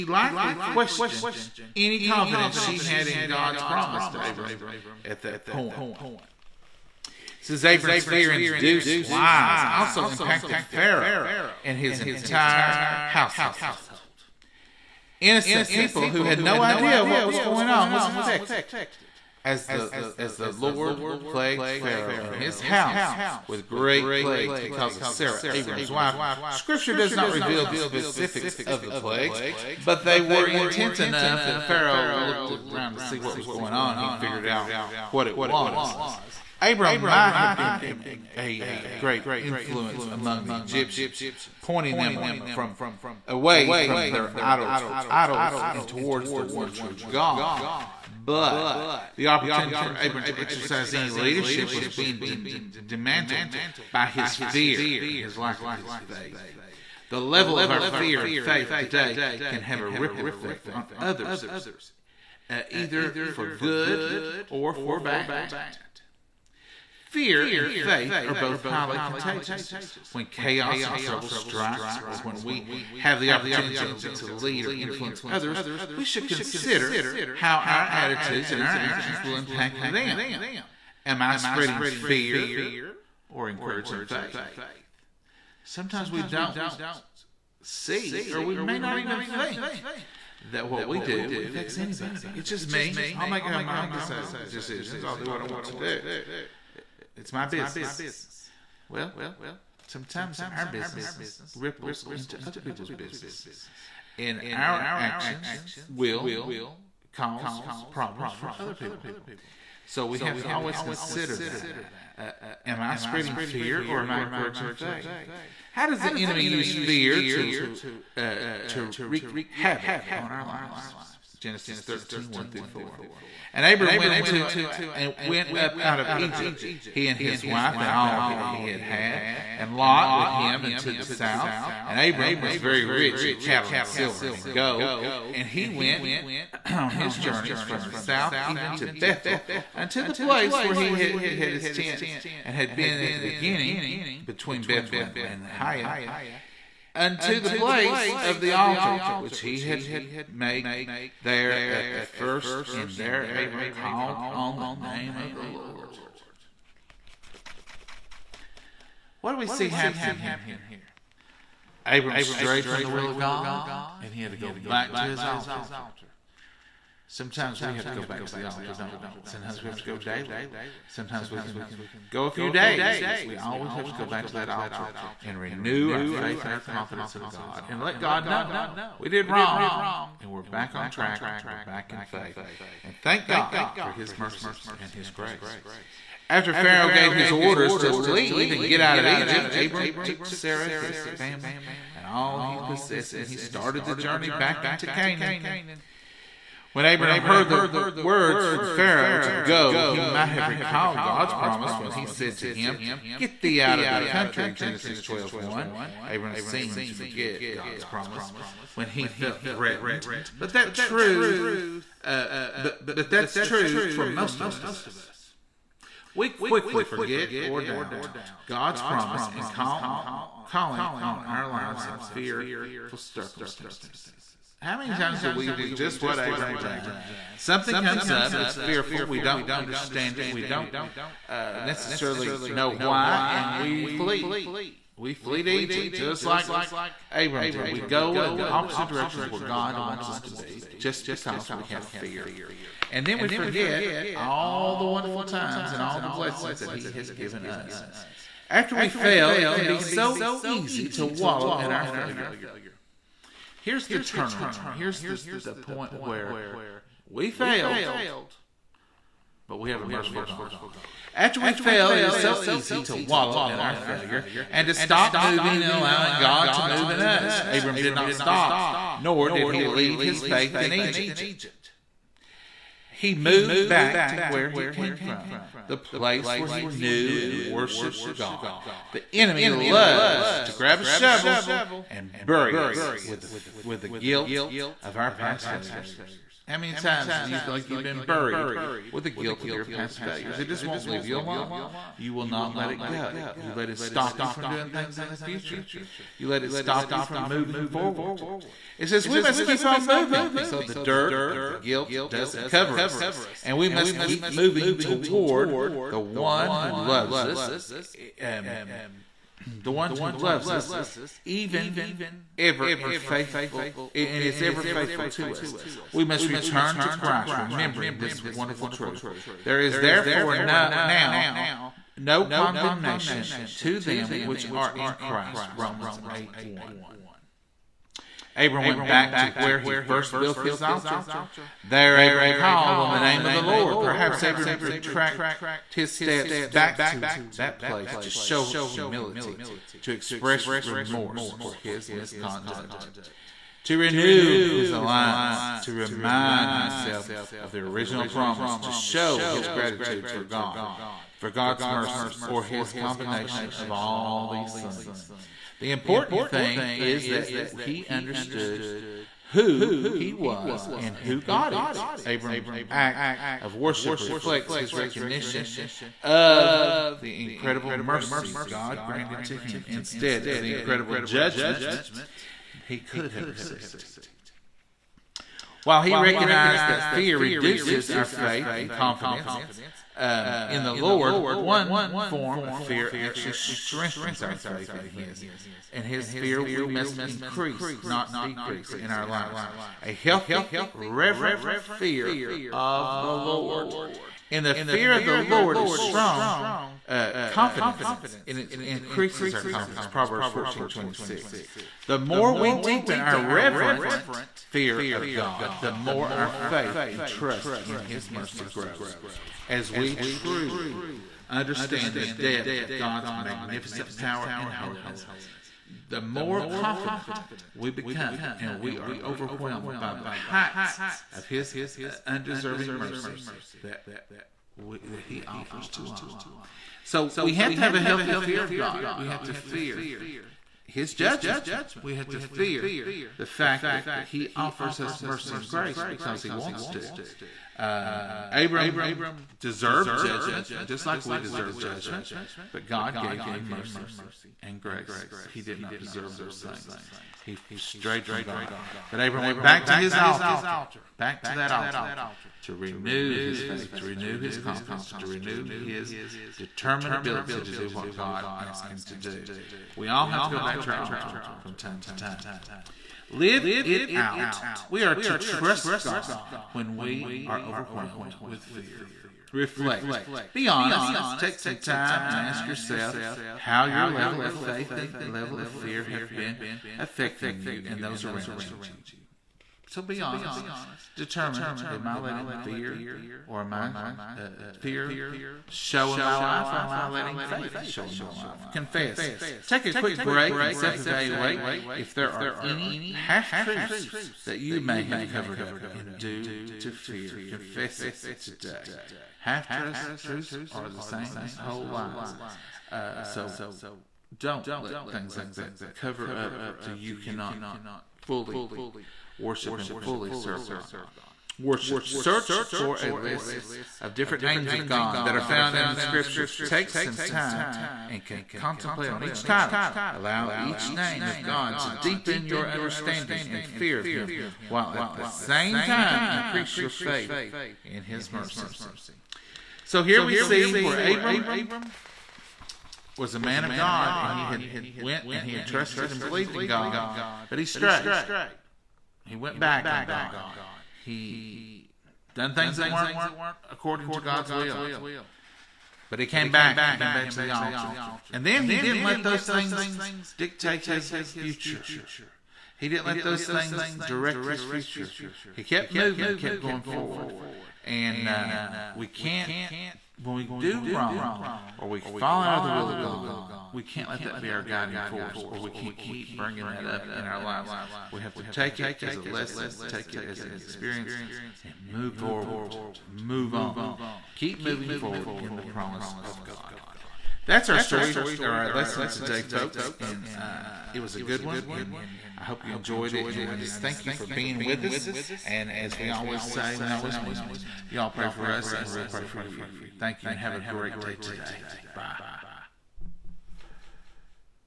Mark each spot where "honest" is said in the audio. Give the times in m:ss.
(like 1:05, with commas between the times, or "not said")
7:50, 8:00.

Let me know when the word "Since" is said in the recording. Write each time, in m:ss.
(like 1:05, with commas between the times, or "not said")
0:07.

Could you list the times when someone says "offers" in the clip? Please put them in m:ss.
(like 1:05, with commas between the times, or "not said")
7:05, 7:14.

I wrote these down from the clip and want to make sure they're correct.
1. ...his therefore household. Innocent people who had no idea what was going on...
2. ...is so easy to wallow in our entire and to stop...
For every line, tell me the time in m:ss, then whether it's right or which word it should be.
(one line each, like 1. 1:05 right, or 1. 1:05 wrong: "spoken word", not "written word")
1. 0:11 wrong: "entire", not "therefore"
2. 4:22 wrong: "failure", not "entire".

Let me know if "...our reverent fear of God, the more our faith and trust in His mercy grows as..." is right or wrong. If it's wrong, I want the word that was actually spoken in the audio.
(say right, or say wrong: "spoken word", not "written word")
right.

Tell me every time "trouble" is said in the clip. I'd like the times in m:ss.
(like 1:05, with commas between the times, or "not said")
1:10.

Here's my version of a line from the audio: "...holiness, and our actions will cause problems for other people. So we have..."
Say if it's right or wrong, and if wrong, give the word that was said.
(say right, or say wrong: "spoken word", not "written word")
wrong: "business", not "holiness".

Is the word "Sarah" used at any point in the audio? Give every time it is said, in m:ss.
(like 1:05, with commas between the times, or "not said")
0:25, 3:10.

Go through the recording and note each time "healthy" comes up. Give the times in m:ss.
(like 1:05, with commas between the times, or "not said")
6:29, 7:07.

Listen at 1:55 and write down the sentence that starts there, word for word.
How does the enemy use fear to uh, to wreak havoc on our lives?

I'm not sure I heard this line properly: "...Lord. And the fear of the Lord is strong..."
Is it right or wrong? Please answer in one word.
right.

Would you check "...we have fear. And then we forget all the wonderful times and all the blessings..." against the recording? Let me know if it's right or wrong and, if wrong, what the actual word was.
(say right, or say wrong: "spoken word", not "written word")
right.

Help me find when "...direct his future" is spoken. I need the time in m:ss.
9:13.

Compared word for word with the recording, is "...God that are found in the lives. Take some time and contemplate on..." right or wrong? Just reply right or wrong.
wrong.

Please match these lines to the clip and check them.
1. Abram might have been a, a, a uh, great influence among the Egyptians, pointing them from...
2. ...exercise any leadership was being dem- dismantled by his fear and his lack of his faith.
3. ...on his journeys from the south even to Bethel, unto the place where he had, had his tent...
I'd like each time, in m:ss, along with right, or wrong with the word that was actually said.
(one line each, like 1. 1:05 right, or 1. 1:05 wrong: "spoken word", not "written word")
1. 0:36 right
2. 0:50 right
3. 2:16 right.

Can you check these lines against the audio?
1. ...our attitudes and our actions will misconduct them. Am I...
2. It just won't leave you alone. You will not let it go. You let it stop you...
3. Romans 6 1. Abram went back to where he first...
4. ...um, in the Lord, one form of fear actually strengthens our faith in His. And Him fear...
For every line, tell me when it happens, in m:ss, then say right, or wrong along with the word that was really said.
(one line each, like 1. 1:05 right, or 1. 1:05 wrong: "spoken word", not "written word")
1. 1:17 wrong: "impact", not "misconduct"
2. 4:50 right
3. 5:25 wrong: "8", not "6"
4. 6:19 wrong: "His", not "Him".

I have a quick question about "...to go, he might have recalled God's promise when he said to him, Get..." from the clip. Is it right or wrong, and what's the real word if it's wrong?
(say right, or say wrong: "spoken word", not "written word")
right.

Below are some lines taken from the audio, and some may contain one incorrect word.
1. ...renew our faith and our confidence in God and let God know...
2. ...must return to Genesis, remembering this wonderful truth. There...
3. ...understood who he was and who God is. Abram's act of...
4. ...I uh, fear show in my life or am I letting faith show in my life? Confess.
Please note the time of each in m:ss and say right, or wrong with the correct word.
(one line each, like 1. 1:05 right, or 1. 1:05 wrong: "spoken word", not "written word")
1. 2:55 right
2. 5:16 wrong: "Christ", not "Genesis"
3. 5:57 right
4. 8:03 right.